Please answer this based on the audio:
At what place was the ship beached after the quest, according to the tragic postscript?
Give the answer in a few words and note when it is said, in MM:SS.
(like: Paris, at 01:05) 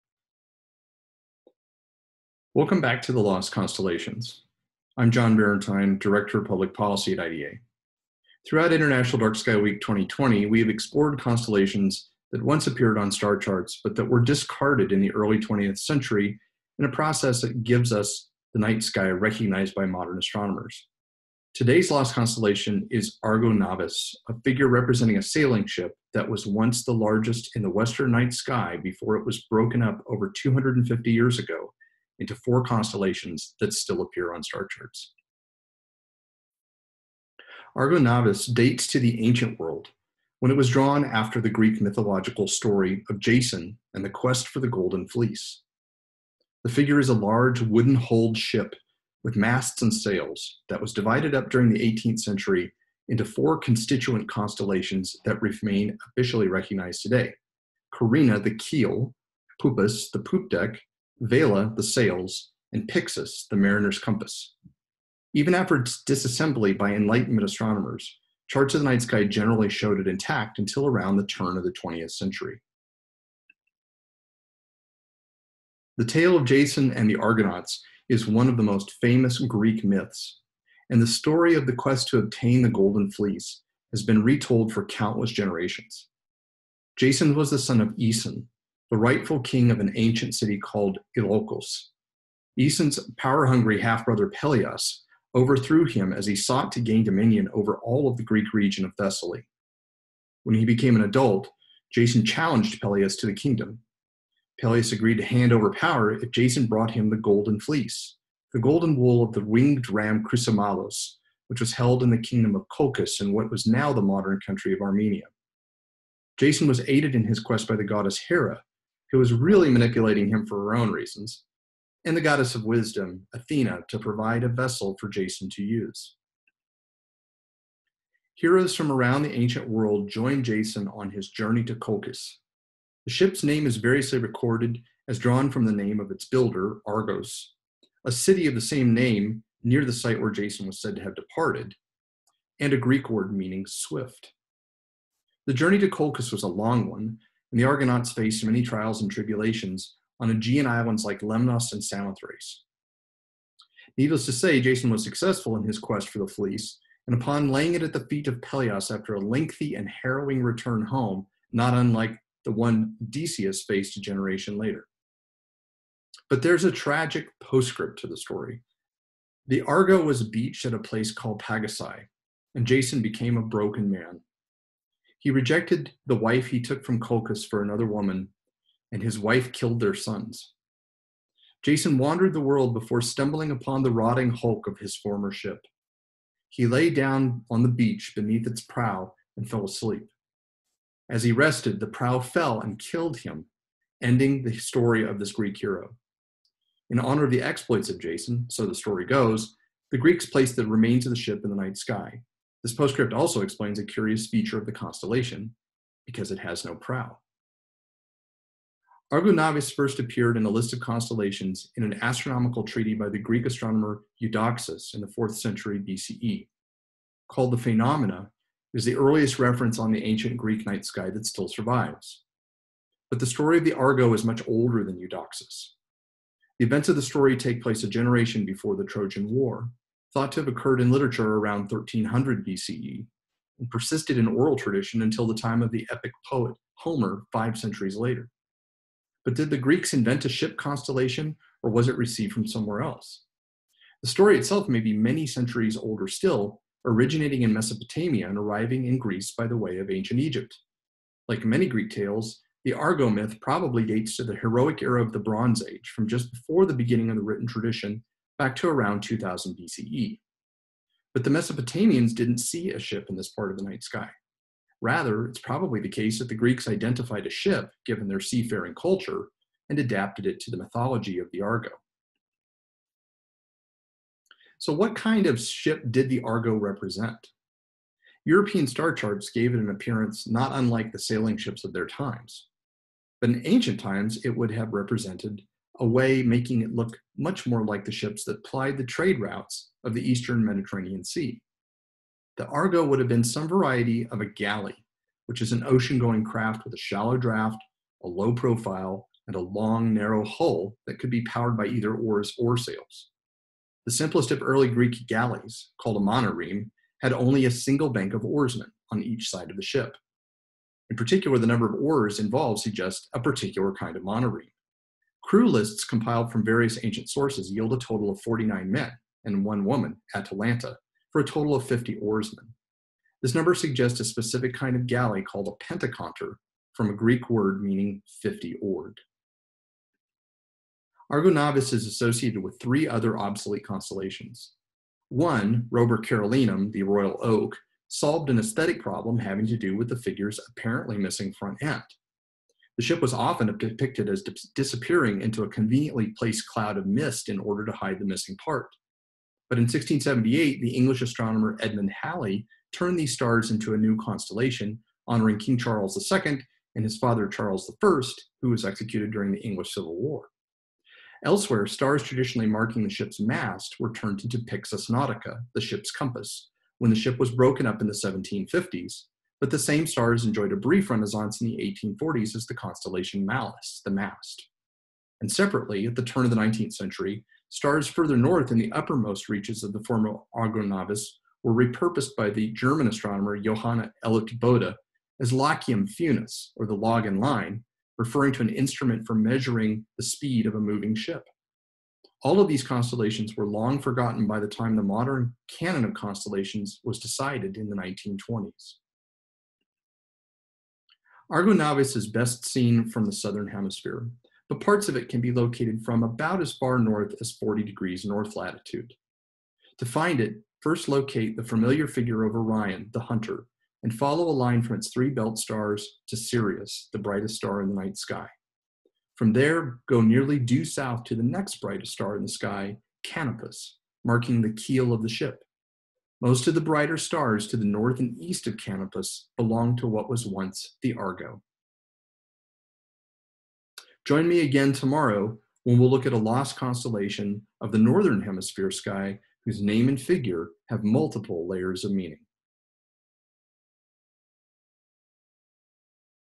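Pagasai, at 02:51.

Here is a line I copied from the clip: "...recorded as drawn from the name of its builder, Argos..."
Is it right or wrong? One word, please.
right.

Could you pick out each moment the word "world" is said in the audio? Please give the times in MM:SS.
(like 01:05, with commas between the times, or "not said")
00:39, 02:09, 03:02.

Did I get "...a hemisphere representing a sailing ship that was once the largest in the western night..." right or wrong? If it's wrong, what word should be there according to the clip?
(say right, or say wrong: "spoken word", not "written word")
wrong: "figure", not "hemisphere".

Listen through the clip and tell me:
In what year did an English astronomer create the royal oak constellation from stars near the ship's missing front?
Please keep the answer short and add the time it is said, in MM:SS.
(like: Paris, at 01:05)
1678, at 05:49.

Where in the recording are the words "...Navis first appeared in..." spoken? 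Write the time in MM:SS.
03:29.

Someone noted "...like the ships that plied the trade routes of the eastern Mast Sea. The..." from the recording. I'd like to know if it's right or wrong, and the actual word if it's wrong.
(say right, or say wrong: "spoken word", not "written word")
wrong: "Mediterranean", not "Mast".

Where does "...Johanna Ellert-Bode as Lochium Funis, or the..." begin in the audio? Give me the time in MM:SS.
06:23.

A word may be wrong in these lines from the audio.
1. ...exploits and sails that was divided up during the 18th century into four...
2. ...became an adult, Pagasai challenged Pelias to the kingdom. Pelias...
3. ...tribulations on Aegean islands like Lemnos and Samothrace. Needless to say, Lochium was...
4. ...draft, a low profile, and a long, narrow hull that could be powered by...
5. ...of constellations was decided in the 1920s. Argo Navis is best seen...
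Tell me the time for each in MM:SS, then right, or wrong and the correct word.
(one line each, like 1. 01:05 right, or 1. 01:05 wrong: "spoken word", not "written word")
1. 00:49 wrong: "masts", not "exploits"
2. 01:40 wrong: "Jason", not "Pagasai"
3. 02:29 wrong: "Jason", not "Lochium"
4. 04:57 right
5. 06:35 right.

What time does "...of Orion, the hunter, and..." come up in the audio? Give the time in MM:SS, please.
06:52.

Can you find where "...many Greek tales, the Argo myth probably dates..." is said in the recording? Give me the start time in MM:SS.
04:11.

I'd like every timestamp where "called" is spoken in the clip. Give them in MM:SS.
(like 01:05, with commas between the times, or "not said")
01:30, 02:51, 03:37, 05:05, 05:25.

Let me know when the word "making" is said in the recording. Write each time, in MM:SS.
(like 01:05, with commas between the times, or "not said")
04:46.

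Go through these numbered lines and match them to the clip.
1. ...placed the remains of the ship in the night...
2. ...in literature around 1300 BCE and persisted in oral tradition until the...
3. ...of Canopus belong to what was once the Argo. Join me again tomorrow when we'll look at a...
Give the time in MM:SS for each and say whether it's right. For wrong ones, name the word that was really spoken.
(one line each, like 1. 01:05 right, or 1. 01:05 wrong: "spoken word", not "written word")
1. 03:20 right
2. 03:50 right
3. 07:08 right.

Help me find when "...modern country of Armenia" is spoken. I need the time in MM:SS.
01:54.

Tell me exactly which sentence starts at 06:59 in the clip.
From there, go nearly due south to the next brightest star in the sky, Canopus, marking the keel of the ship.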